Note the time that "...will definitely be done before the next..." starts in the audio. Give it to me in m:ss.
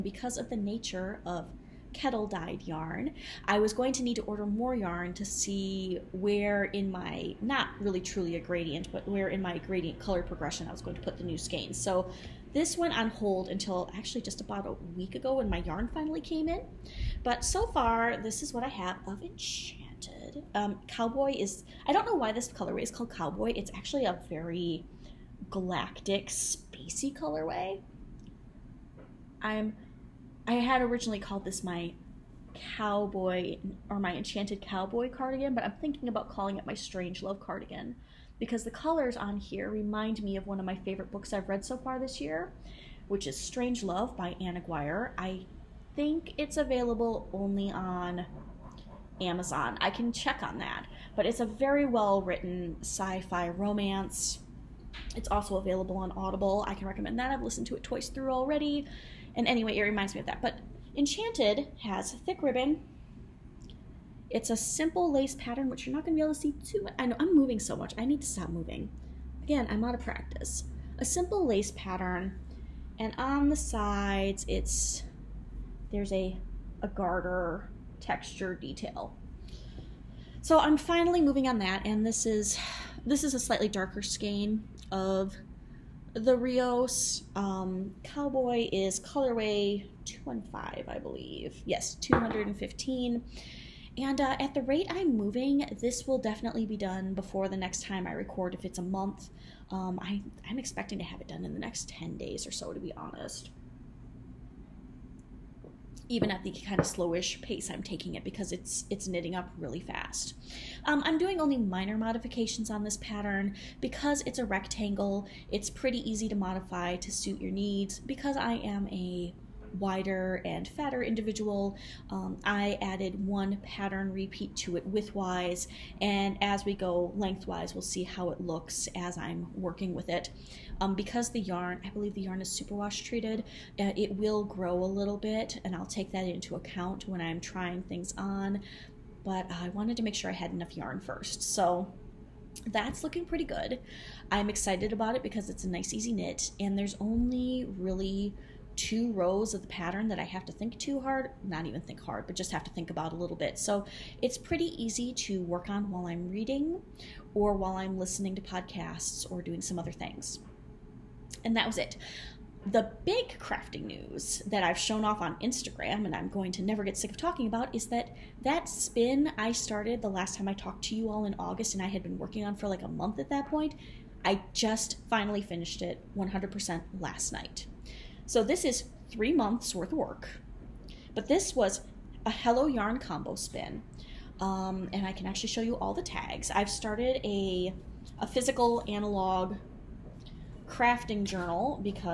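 1:36.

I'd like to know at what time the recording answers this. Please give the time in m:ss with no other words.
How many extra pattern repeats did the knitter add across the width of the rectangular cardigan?
2:03.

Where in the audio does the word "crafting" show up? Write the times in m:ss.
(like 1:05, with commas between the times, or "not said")
2:43, 3:10.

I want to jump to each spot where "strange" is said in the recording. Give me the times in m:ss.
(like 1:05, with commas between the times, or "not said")
0:36, 0:43.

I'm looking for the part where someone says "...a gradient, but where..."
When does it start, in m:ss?
0:08.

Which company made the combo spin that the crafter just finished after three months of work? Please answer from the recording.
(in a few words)
Hello Yarn.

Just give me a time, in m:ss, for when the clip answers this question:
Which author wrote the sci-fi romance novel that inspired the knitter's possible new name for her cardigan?
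0:44.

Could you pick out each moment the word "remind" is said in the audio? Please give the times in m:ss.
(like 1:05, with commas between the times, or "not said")
0:39, 0:59.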